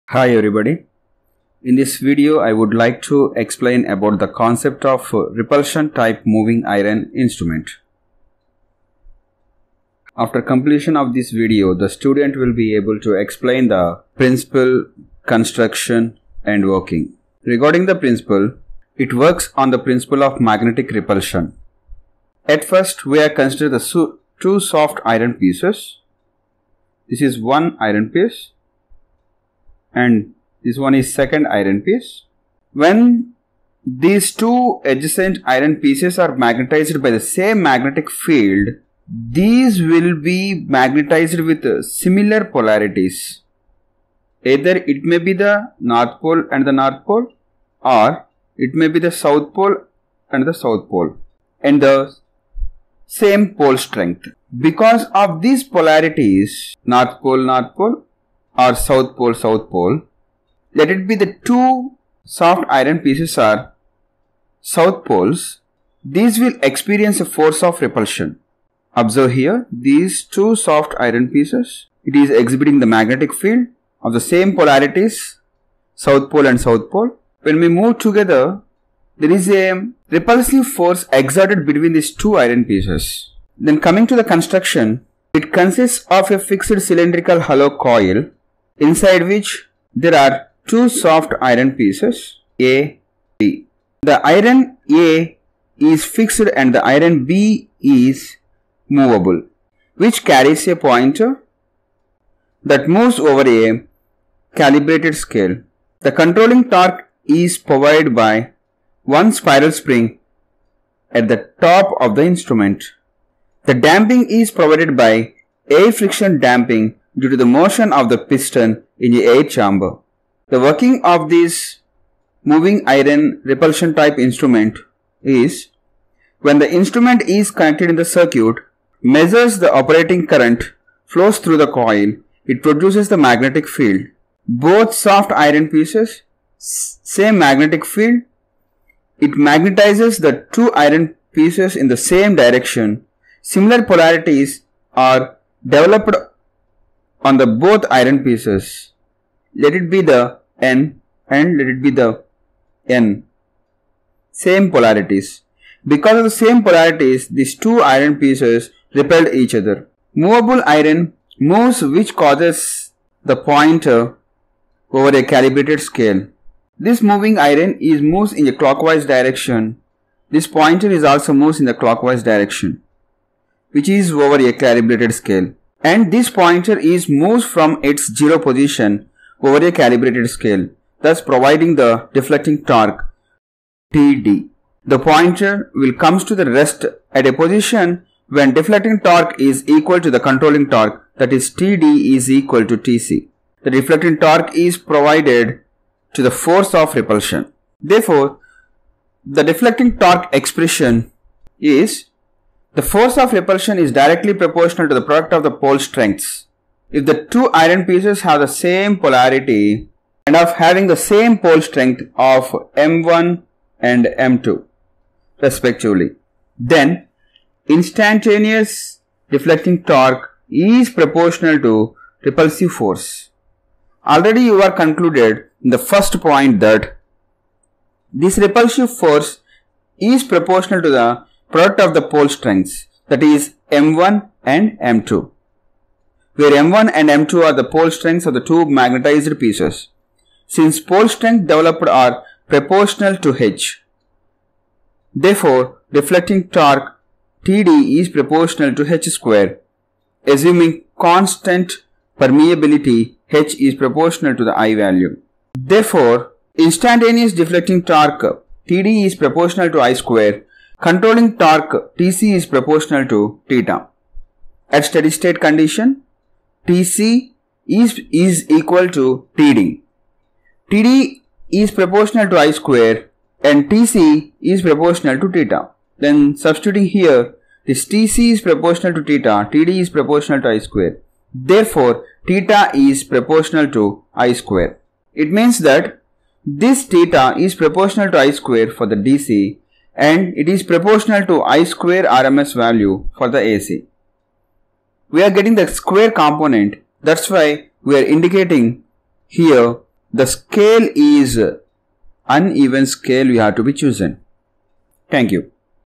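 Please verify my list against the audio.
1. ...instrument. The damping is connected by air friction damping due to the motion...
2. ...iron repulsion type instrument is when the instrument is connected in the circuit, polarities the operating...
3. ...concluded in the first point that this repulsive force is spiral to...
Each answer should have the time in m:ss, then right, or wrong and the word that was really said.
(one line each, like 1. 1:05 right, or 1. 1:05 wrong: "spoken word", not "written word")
1. 1:52 wrong: "provided", not "connected"
2. 2:02 wrong: "measures", not "polarities"
3. 3:44 wrong: "proportional", not "spiral".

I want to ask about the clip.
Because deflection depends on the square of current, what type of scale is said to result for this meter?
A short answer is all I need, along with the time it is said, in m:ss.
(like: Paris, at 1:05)
Uneven scale, at 5:02.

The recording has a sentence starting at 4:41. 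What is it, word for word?
Therefore, theta is proportional to I square.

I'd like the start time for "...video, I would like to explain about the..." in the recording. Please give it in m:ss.
0:02.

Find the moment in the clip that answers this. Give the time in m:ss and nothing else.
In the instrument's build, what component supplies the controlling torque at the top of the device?
1:49.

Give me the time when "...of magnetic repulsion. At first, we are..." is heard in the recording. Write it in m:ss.
0:20.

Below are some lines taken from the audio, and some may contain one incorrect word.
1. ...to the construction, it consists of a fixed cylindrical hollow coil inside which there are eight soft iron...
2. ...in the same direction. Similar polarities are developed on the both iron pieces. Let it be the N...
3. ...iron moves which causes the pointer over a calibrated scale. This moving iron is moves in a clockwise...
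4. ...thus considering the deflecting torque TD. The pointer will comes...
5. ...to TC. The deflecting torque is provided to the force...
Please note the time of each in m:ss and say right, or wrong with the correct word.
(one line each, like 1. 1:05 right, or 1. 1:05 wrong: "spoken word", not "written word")
1. 1:24 wrong: "two", not "eight"
2. 2:21 right
3. 2:40 right
4. 3:01 wrong: "providing", not "considering"
5. 3:12 right.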